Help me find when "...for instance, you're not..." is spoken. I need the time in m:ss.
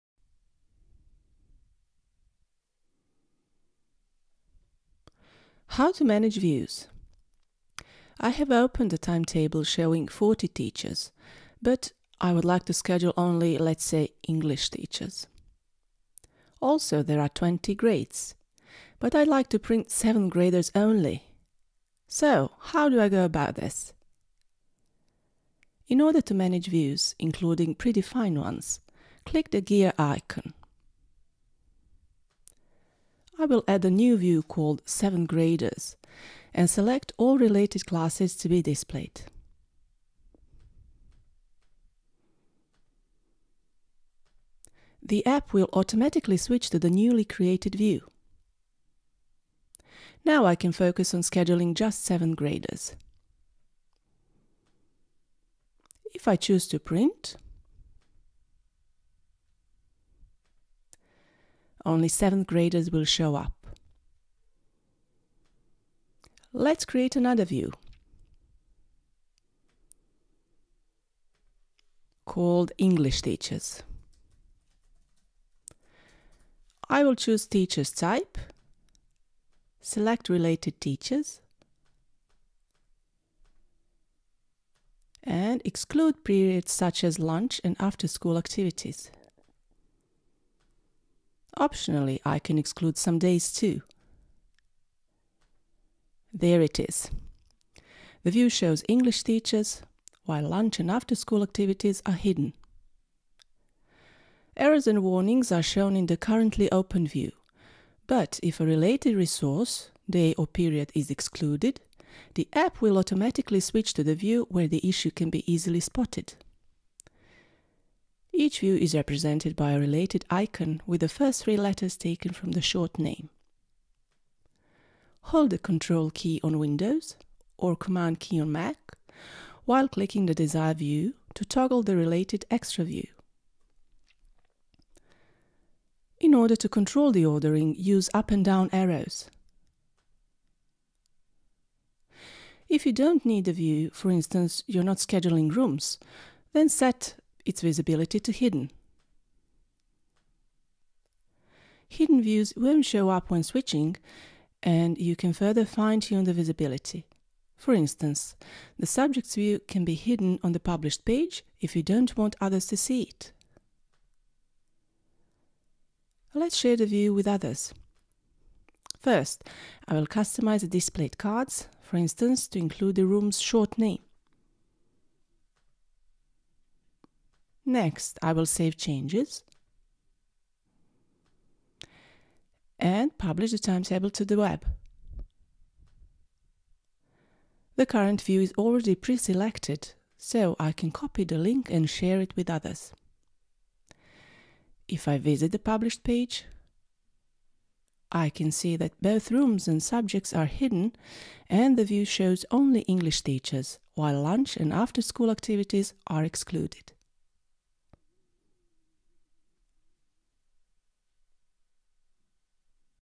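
2:23.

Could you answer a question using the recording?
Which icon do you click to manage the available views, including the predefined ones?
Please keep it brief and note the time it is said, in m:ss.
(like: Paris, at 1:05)
gear icon, at 0:29.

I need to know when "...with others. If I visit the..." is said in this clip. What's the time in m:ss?
3:12.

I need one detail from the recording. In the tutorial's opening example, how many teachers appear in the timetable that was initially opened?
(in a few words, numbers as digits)
40.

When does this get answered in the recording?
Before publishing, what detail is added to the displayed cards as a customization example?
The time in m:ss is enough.
2:53.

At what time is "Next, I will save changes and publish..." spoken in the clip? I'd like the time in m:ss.
2:57.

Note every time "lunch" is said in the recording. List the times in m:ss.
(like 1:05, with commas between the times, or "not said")
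1:27, 1:40, 3:24.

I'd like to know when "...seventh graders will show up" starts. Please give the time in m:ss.
1:02.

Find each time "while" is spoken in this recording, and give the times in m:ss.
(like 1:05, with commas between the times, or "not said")
1:40, 2:09, 3:23.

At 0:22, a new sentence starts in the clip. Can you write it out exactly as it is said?
So, how do I go about this?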